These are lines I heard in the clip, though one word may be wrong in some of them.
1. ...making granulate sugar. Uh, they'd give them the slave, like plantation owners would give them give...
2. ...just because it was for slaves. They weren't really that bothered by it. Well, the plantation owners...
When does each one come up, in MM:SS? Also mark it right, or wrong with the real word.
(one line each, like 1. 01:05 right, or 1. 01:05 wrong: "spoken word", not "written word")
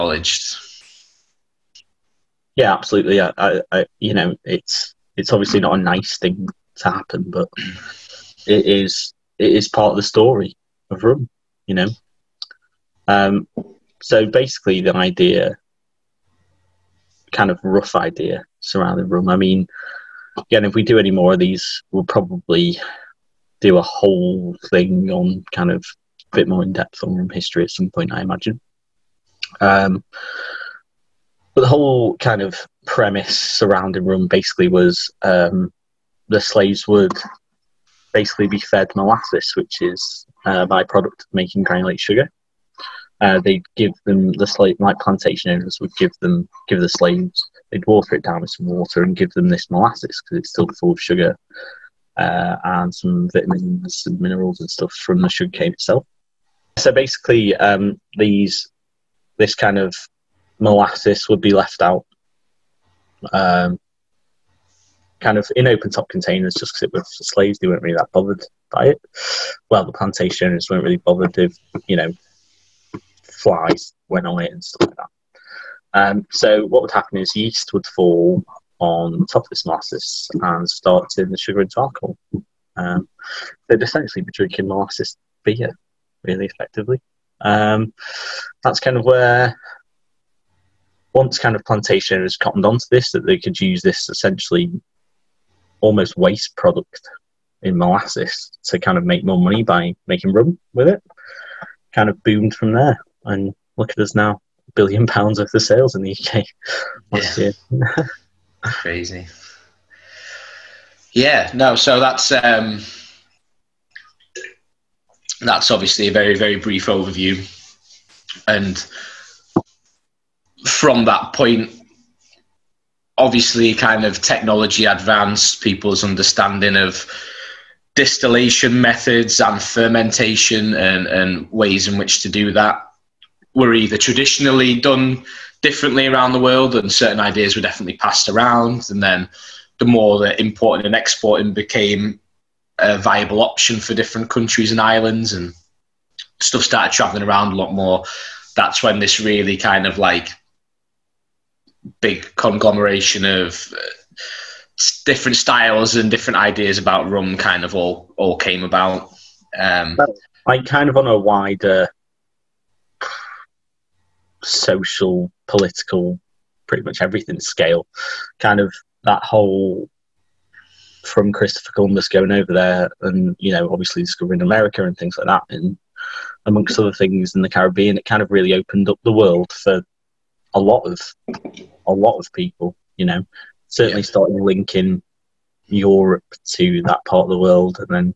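1. 00:41 right
2. 01:06 right.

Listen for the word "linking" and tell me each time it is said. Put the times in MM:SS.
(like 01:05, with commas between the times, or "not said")
03:04.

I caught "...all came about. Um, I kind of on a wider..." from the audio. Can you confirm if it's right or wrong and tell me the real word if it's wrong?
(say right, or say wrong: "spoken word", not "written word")
right.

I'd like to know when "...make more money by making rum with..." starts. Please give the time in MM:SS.
01:39.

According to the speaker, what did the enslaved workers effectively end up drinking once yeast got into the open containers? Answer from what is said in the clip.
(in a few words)
Molasses beer.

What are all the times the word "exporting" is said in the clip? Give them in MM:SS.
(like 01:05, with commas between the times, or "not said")
02:20.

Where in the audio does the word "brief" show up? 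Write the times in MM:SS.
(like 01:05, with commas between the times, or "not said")
01:56.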